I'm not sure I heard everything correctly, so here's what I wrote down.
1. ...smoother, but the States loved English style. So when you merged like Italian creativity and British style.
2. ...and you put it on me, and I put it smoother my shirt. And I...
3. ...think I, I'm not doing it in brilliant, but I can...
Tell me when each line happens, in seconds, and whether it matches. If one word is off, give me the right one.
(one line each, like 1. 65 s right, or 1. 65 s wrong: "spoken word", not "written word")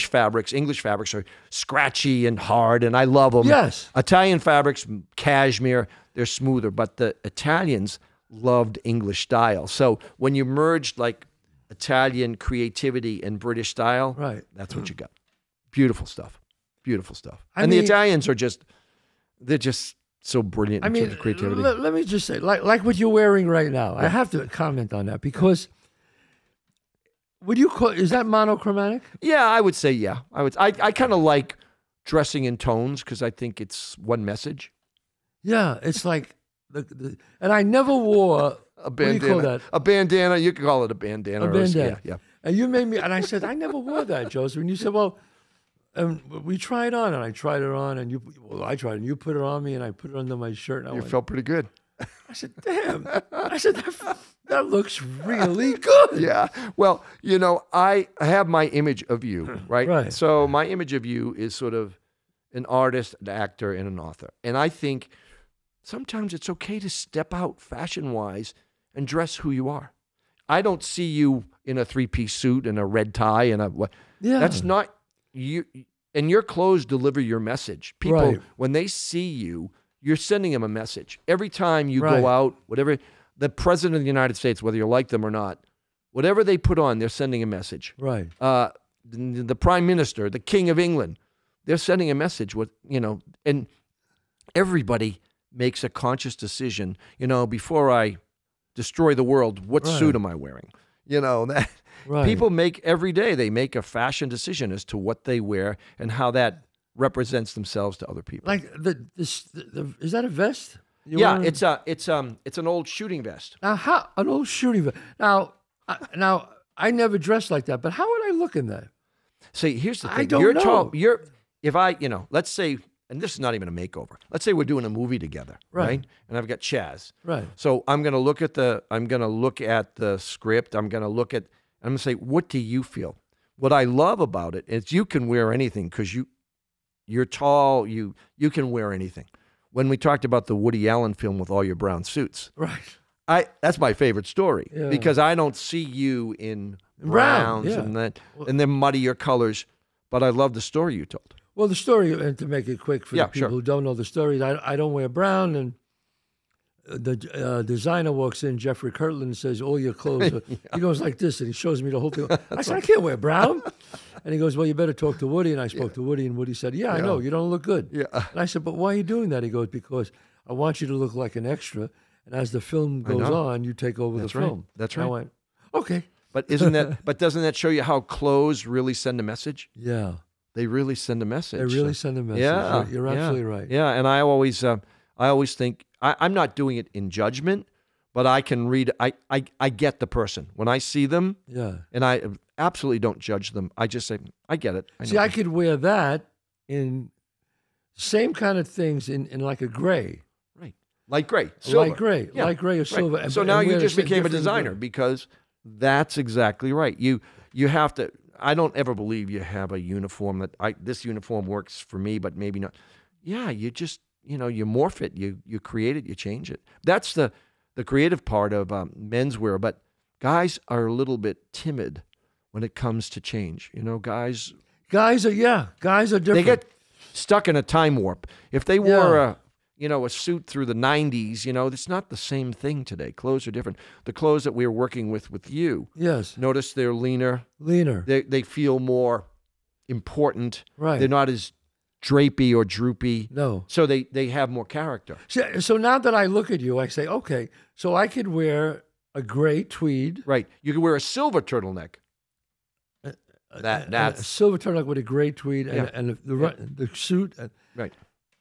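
1. 6 s wrong: "Italians", not "States"
2. 48 s wrong: "under", not "smoother"
3. 185 s wrong: "judgment", not "brilliant".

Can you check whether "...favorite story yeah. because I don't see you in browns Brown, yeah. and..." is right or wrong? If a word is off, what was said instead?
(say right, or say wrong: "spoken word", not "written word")
right.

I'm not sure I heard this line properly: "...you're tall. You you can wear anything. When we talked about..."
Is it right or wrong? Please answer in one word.
right.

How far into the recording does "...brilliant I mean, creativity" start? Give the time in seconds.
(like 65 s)
20 s.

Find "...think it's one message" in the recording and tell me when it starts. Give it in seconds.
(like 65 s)
33 s.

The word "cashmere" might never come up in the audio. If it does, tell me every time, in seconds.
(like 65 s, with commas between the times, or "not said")
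5 s.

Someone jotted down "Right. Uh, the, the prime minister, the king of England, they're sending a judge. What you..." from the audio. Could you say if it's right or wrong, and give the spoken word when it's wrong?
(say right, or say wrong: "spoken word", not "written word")
wrong: "message", not "judge".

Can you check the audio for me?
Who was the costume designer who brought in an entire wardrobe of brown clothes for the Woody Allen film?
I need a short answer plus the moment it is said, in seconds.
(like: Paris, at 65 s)
Jeffrey Kurland, at 158 s.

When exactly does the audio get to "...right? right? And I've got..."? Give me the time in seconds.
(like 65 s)
125 s.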